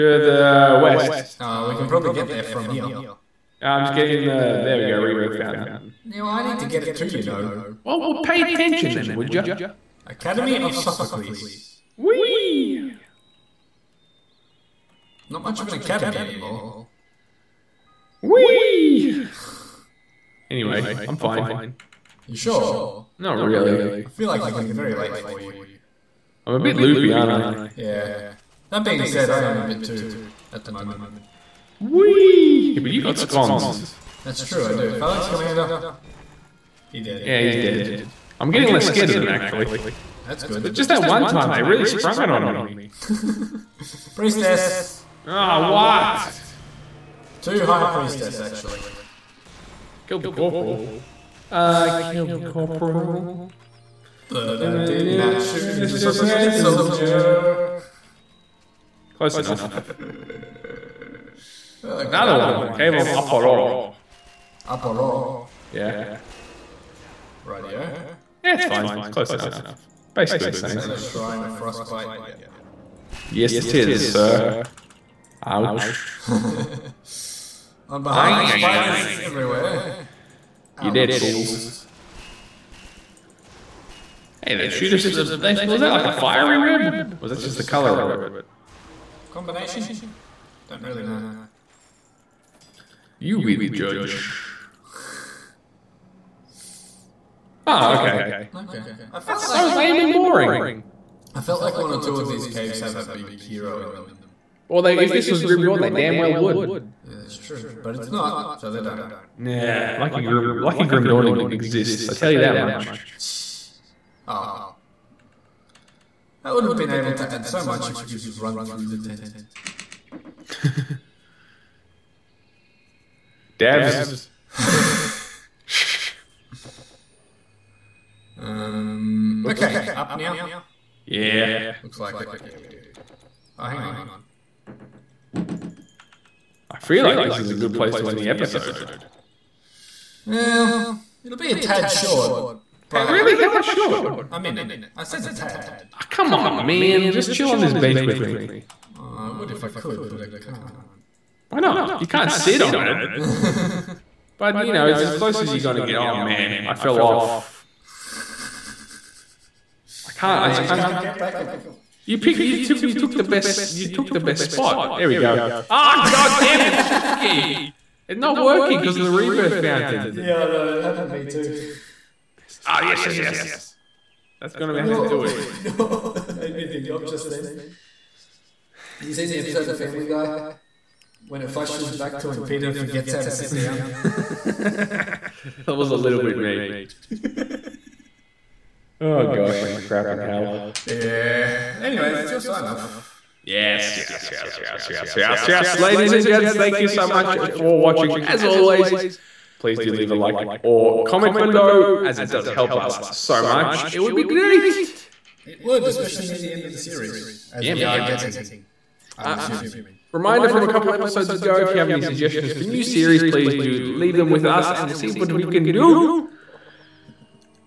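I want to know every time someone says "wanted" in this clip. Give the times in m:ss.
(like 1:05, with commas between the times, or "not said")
not said.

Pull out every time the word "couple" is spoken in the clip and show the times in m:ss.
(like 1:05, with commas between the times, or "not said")
3:30.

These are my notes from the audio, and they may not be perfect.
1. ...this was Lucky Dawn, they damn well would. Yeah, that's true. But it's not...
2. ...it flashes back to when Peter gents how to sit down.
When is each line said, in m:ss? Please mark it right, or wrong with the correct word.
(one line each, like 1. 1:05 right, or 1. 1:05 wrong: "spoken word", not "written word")
1. 1:45 wrong: "Grim", not "Lucky"
2. 3:01 wrong: "forgets", not "gents".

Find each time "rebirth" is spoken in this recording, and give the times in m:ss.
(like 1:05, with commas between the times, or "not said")
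0:04, 2:49.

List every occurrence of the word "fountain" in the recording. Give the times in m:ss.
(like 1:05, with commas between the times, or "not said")
0:05, 2:49.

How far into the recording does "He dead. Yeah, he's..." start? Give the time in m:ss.
0:36.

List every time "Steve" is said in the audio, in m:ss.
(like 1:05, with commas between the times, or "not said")
not said.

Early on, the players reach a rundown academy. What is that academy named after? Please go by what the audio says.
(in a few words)
Sophocles.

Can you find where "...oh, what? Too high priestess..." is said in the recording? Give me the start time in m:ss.
0:45.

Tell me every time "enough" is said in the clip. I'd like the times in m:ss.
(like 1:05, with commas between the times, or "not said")
0:59, 1:09.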